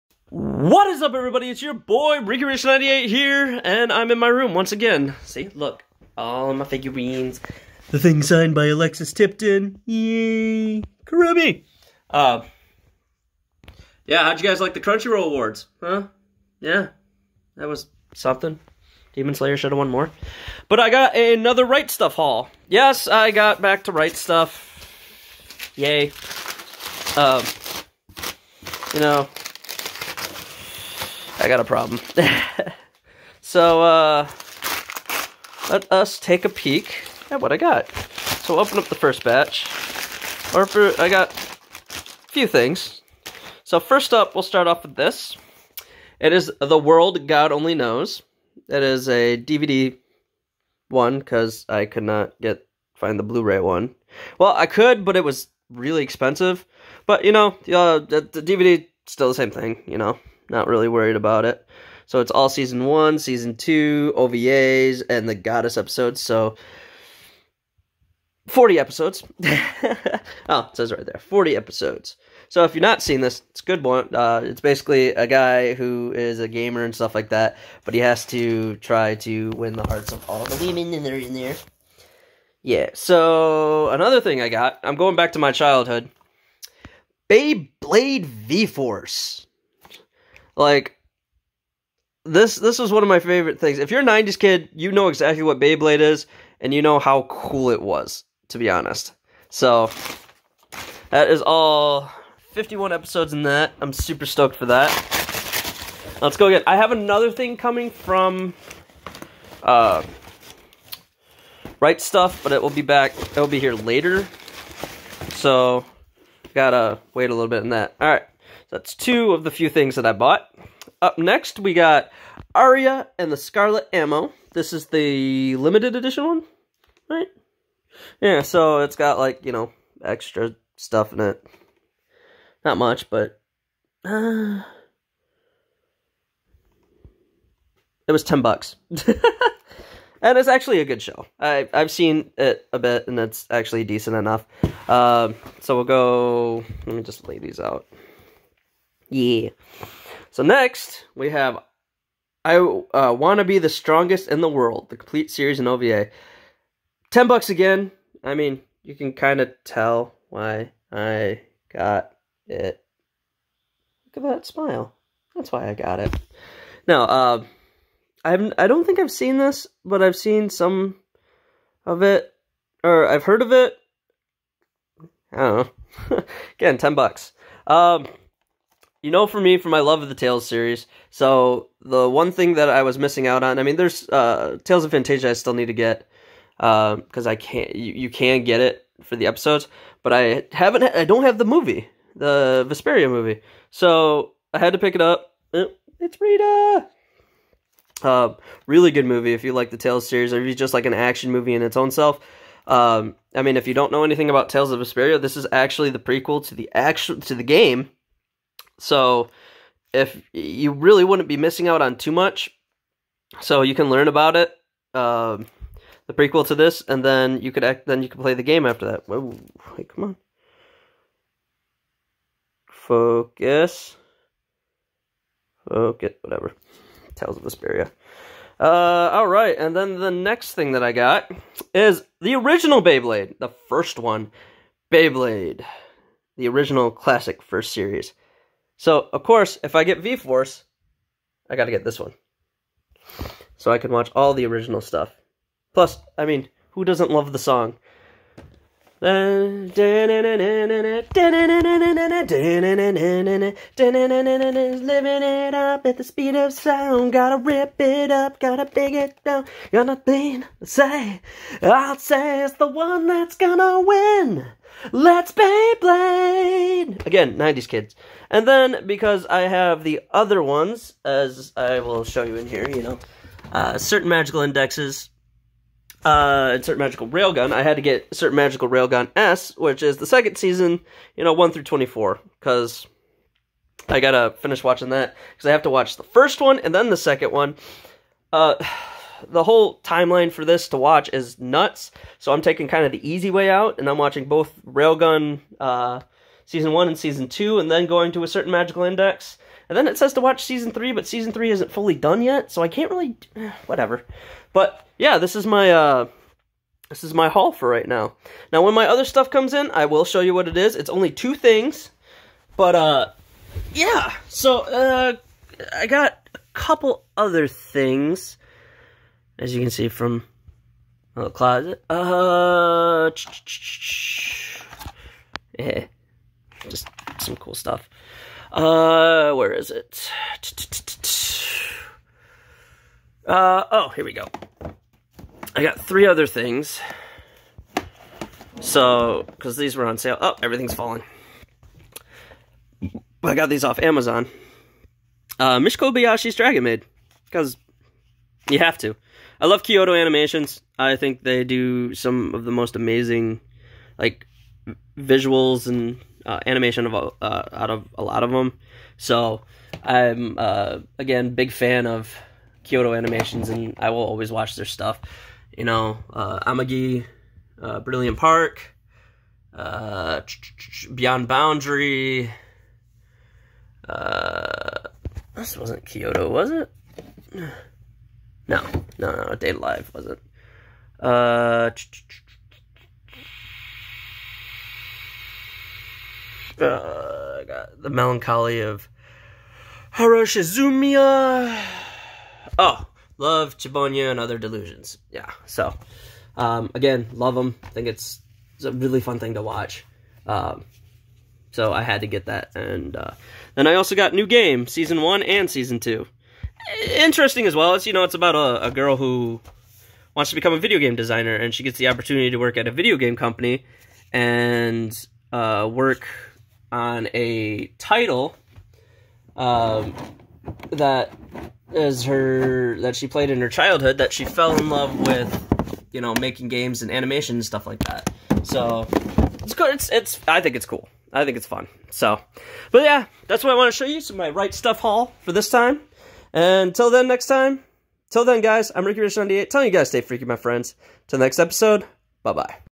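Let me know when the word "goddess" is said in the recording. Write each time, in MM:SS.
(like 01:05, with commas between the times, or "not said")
01:05.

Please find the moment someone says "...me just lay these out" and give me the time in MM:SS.
02:26.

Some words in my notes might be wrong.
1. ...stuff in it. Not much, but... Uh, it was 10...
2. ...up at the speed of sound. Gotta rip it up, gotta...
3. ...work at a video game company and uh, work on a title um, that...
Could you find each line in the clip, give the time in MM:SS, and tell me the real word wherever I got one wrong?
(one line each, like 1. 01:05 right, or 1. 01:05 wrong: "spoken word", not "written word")
1. 02:10 right
2. 04:15 right
3. 06:52 right.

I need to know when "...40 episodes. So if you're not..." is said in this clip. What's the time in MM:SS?
01:11.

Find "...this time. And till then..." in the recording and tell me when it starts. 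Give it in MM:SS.
07:15.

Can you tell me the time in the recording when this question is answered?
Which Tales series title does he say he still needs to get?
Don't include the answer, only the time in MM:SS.
03:04.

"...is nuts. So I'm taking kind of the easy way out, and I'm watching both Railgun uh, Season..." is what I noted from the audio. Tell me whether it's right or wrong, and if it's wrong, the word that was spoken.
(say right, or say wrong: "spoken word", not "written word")
right.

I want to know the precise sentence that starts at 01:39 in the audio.
So that is all 51 episodes in that.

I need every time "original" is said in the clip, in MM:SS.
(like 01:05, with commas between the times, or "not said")
03:52, 03:56, 04:04.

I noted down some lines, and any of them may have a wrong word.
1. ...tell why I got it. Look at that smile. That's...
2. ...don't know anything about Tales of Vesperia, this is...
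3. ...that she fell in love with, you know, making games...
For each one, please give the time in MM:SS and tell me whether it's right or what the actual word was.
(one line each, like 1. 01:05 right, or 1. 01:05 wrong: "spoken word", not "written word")
1. 02:39 right
2. 03:23 right
3. 07:03 right.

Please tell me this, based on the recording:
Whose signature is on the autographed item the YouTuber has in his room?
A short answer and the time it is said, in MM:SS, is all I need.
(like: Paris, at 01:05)
Alexis Tipton, at 00:08.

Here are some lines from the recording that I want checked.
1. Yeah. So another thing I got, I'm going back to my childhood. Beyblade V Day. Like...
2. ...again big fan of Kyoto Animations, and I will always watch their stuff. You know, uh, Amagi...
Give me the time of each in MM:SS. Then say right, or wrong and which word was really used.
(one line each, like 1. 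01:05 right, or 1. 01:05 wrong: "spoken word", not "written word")
1. 01:22 wrong: "Force", not "Day"
2. 06:00 right.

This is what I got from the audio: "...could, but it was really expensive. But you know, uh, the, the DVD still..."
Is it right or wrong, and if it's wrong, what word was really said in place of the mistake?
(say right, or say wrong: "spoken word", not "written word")
right.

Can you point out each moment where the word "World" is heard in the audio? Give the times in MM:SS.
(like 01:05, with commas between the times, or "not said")
00:46, 02:34.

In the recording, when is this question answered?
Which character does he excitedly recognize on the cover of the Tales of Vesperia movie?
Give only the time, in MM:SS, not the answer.
03:16.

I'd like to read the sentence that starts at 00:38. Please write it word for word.
So open up the first batch.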